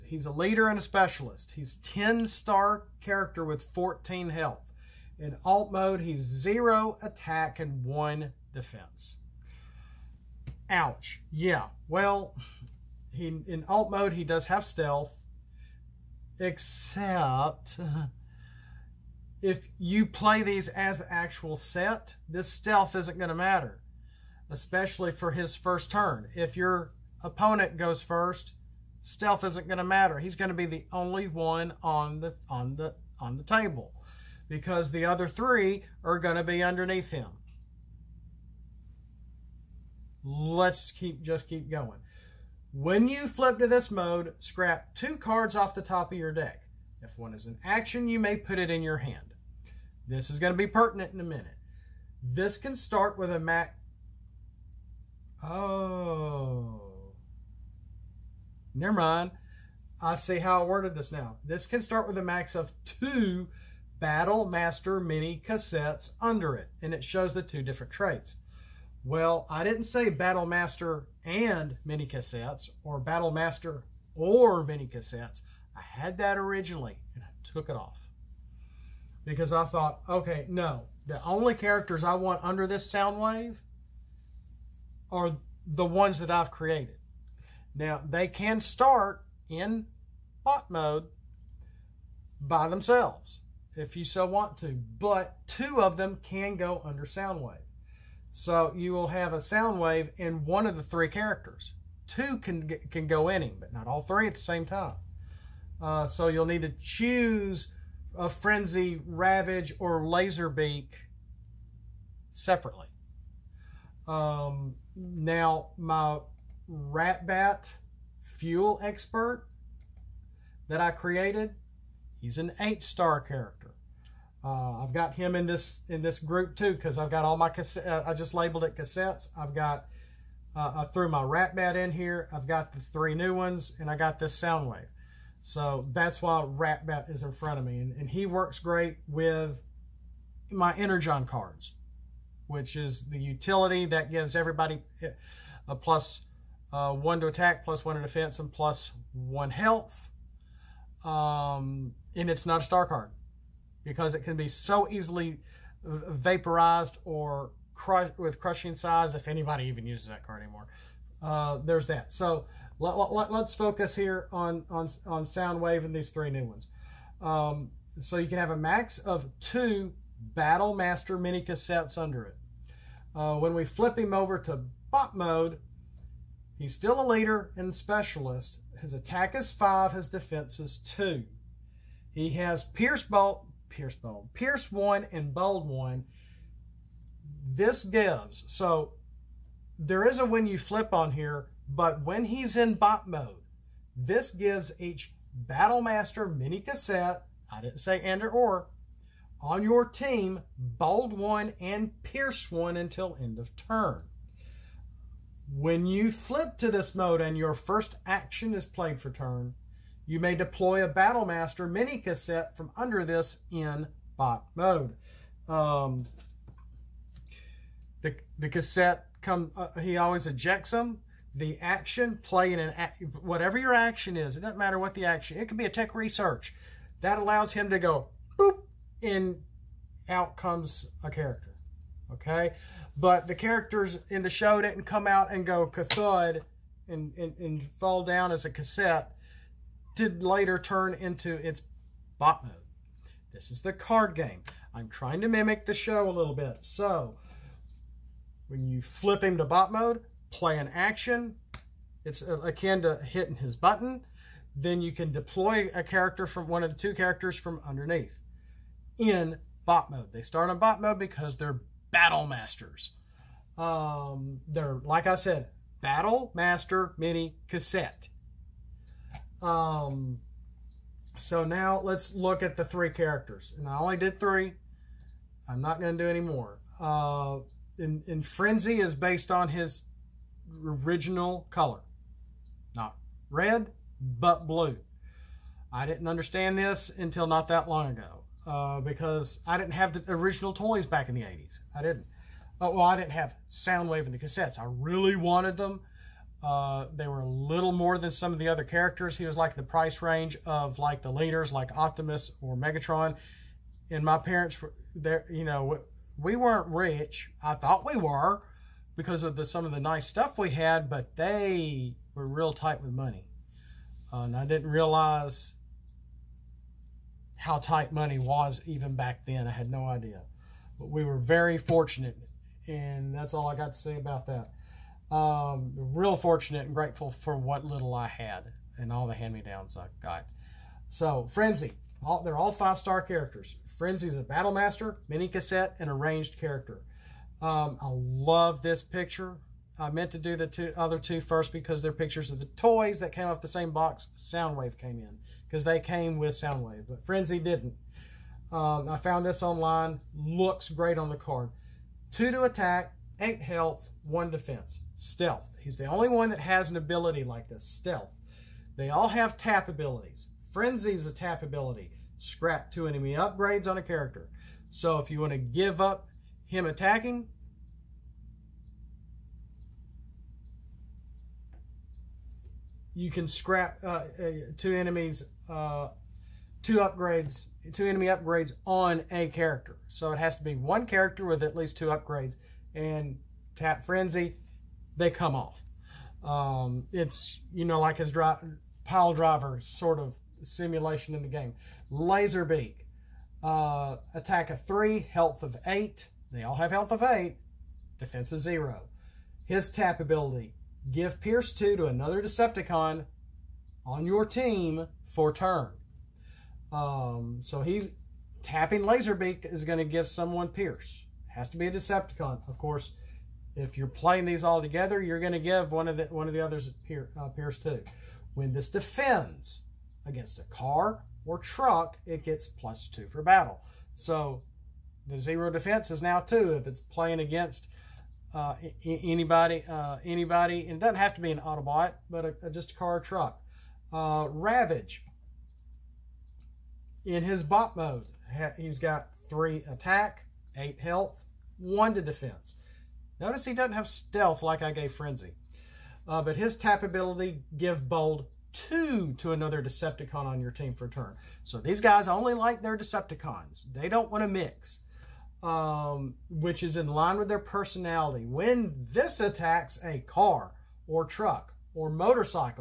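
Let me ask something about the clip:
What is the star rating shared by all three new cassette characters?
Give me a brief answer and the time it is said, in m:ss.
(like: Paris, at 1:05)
5, at 5:32.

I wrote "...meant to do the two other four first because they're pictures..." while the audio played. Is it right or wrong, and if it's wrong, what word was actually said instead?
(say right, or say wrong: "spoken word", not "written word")
wrong: "two", not "four".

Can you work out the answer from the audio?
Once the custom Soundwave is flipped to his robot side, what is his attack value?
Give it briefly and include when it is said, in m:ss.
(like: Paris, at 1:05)
5, at 2:59.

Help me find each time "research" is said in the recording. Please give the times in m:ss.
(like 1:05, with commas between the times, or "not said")
3:45.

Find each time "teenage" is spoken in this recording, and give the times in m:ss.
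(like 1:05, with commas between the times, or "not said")
not said.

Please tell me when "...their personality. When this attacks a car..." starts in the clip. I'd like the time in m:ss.
7:37.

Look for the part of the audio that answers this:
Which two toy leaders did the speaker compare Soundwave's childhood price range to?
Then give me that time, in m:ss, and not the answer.
5:01.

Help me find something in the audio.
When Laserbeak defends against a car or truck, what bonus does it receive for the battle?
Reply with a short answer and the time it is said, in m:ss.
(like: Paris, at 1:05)
+2, at 7:02.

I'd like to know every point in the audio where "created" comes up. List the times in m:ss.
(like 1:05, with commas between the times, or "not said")
1:26, 2:00.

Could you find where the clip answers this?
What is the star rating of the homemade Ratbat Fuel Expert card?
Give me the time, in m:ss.
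2:02.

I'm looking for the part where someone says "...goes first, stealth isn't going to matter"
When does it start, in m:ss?
0:27.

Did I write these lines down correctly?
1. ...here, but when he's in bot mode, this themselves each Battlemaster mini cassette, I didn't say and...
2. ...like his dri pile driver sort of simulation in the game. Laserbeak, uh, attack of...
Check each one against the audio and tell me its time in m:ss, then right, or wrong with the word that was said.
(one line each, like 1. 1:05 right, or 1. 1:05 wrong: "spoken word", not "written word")
1. 3:11 wrong: "gives", not "themselves"
2. 6:27 right.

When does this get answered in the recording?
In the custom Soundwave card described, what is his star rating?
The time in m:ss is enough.
0:01.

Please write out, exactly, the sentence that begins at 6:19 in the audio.
So it has to be one character with at least two upgrades.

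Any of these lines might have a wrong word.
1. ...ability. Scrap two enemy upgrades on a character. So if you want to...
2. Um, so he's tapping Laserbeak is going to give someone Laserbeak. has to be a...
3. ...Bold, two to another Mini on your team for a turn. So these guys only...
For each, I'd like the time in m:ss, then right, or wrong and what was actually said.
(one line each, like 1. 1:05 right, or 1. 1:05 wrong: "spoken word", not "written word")
1. 6:01 right
2. 6:46 wrong: "Pierce", not "Laserbeak"
3. 7:27 wrong: "Decepticon", not "Mini".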